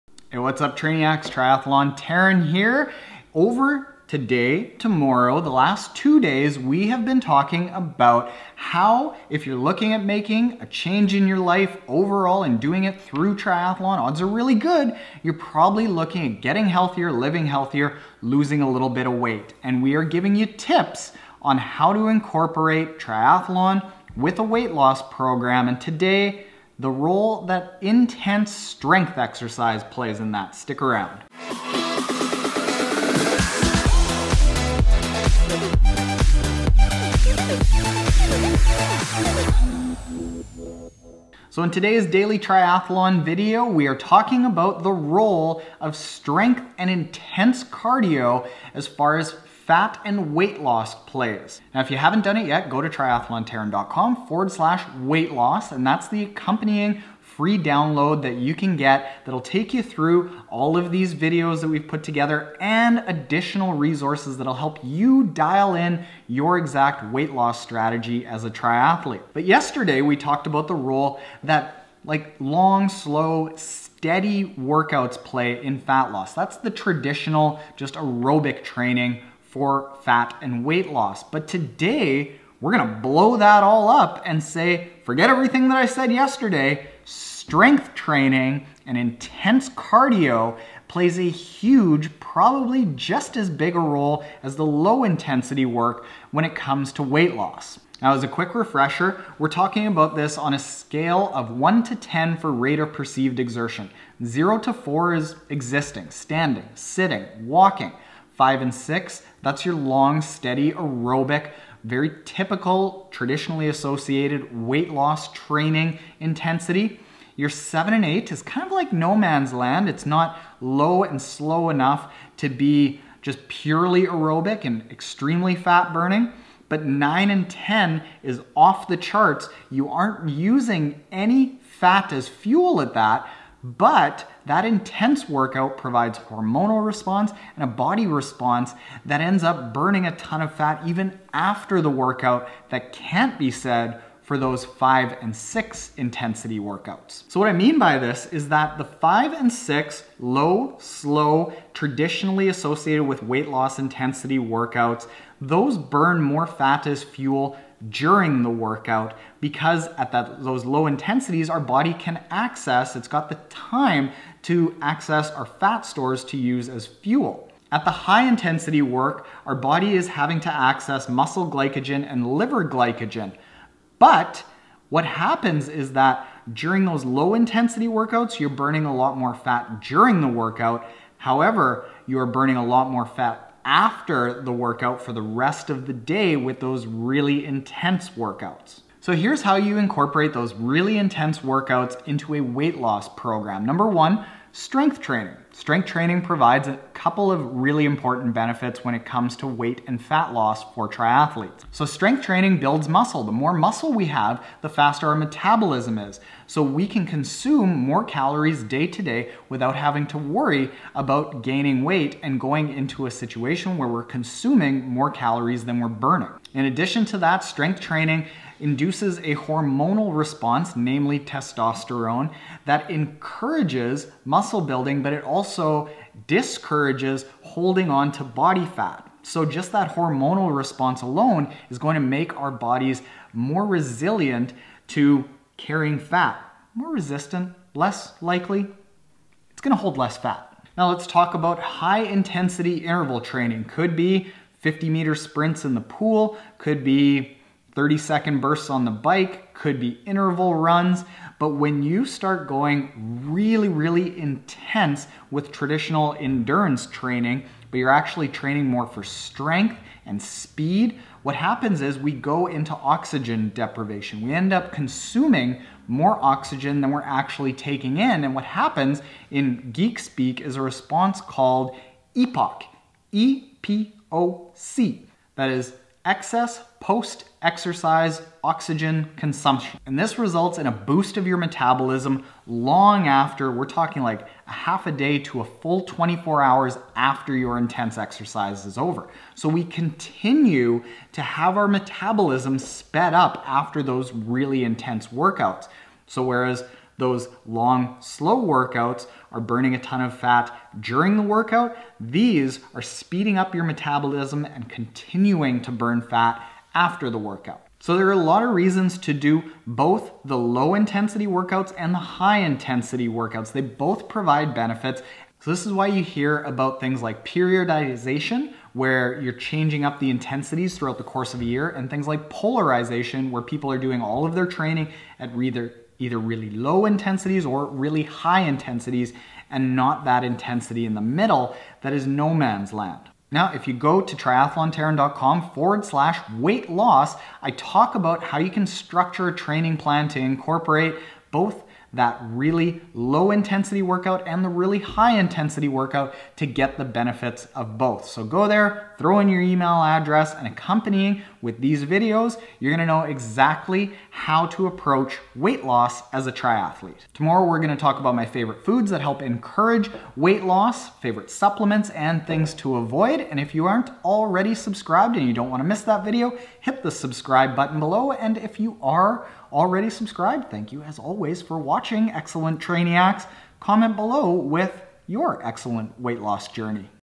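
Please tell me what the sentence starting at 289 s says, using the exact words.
So we continue to have our metabolism sped up after those really intense workouts.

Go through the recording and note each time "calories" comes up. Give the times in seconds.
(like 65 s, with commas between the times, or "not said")
208 s, 215 s.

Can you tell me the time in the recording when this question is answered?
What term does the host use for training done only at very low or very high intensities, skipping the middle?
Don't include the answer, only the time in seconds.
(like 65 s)
322 s.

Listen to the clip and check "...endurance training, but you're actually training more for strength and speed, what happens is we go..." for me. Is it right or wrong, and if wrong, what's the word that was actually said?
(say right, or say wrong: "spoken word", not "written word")
right.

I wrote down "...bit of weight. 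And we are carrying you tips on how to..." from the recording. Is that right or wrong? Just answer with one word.
wrong.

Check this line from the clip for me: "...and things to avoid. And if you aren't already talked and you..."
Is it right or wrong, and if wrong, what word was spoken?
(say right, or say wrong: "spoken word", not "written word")
wrong: "subscribed", not "talked".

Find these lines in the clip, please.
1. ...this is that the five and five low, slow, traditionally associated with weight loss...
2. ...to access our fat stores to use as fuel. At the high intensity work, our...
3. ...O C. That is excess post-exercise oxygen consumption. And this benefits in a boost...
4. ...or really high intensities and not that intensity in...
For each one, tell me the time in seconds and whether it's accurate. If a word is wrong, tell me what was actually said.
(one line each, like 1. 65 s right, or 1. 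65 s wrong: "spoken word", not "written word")
1. 147 s wrong: "six", not "five"
2. 164 s right
3. 274 s wrong: "results", not "benefits"
4. 327 s right.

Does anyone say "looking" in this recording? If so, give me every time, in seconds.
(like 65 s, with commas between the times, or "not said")
9 s, 15 s.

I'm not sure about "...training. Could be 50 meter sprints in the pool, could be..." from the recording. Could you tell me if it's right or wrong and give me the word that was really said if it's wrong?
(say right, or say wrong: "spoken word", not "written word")
right.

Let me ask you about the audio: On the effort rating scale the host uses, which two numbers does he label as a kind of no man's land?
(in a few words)
7 and 8.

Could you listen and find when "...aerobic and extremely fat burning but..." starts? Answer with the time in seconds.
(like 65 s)
124 s.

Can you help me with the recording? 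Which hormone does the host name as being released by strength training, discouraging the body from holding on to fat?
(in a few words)
Testosterone.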